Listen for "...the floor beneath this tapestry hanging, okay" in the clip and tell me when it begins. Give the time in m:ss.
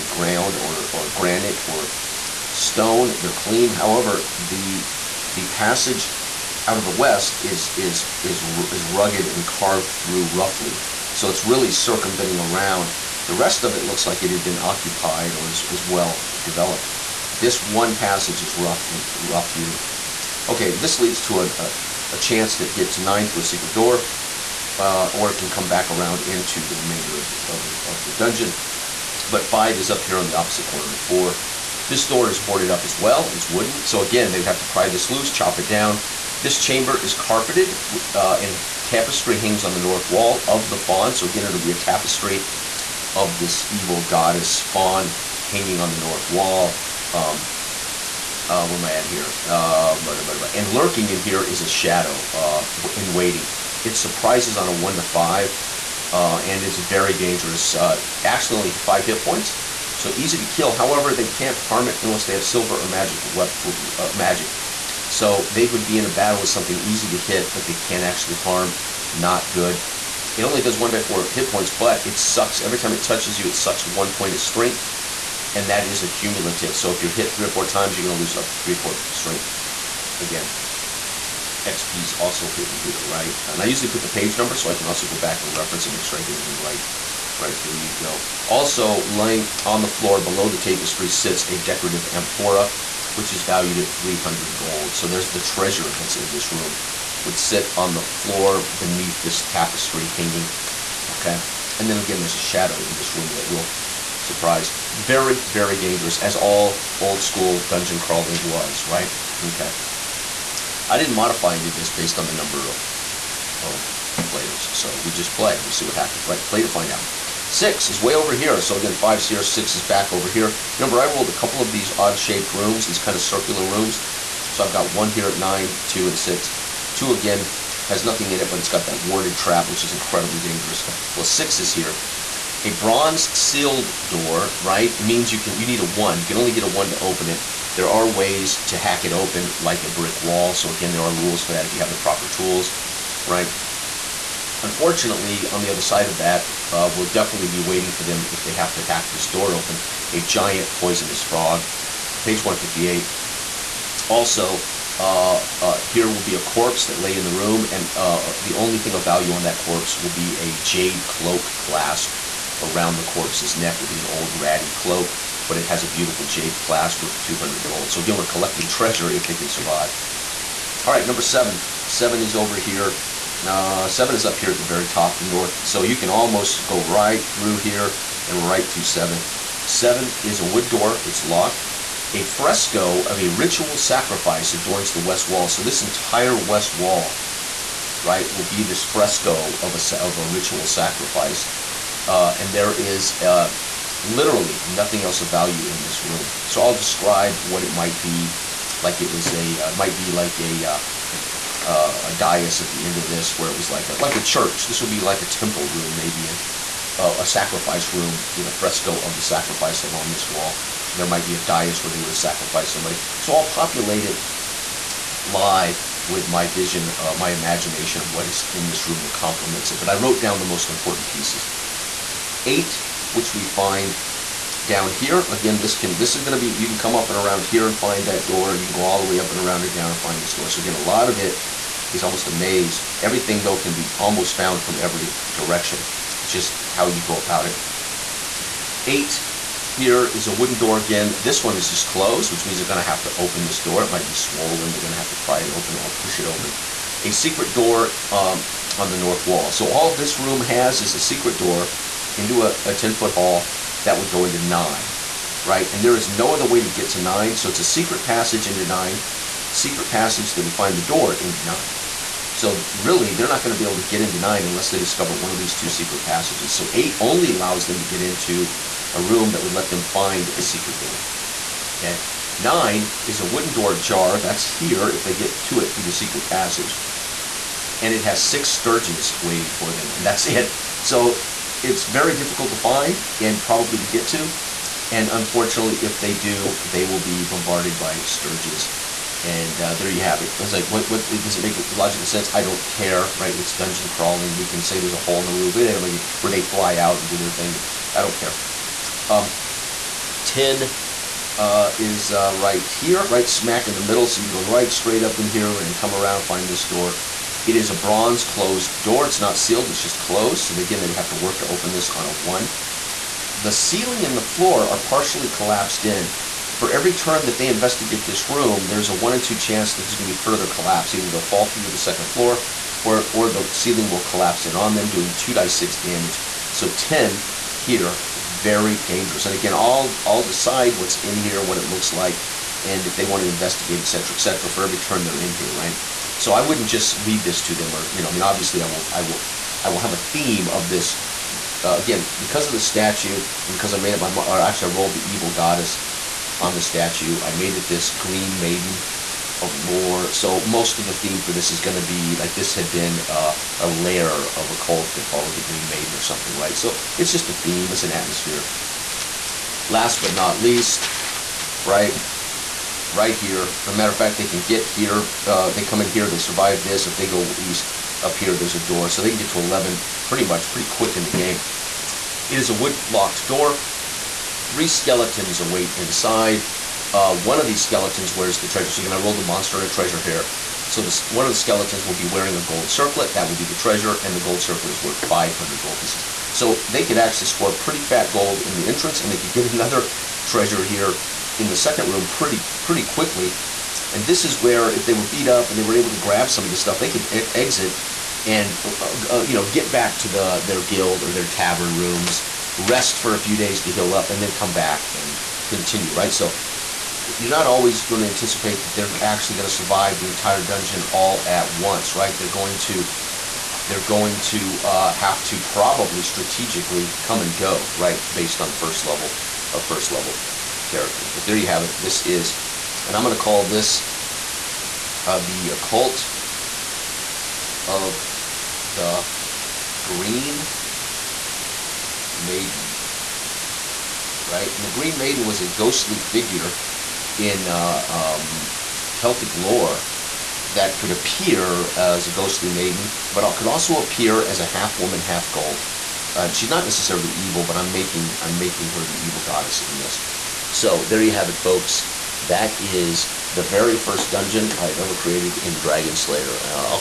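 1:37.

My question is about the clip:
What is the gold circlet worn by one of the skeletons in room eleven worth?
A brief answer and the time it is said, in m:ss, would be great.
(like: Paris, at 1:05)
500 gold pieces, at 6:25.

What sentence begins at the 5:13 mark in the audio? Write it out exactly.
The ceiling and the floor are partially collapsed in.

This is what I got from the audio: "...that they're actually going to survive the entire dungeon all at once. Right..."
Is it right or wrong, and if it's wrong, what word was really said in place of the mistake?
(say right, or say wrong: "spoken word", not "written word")
right.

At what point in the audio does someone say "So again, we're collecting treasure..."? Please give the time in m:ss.
2:47.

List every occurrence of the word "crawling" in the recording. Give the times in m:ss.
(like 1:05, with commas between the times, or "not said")
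1:47, 4:53.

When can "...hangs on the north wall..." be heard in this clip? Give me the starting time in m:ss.
0:39.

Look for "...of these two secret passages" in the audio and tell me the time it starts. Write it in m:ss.
4:25.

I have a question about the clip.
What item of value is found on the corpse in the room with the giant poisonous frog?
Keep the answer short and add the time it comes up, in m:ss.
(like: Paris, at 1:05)
Jade cloak clasp, at 2:40.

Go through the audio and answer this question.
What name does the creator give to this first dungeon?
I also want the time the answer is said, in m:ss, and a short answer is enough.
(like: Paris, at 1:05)
The Occult of the Green Maiden, at 7:05.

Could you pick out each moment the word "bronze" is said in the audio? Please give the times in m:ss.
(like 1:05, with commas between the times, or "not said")
2:12, 5:07.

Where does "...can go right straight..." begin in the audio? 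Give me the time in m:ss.
5:04.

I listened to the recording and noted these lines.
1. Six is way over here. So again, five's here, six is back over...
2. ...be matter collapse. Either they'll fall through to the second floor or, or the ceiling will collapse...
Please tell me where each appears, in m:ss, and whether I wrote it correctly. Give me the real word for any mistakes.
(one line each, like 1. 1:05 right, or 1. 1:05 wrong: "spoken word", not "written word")
1. 1:57 right
2. 5:20 wrong: "further", not "matter".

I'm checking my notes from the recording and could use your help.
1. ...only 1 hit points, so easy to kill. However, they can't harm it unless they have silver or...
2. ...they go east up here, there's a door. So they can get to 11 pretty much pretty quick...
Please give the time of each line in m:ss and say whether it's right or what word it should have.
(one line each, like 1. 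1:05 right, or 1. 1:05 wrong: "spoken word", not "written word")
1. 0:58 wrong: "5", not "1"
2. 6:06 right.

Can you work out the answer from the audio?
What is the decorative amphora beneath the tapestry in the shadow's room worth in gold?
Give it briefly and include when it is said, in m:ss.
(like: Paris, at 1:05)
300 gold, at 1:33.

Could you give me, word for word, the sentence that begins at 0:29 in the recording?
But 5 is up here on the opposite corner of 4.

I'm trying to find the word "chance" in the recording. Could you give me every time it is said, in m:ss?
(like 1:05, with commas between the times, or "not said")
0:22, 5:19.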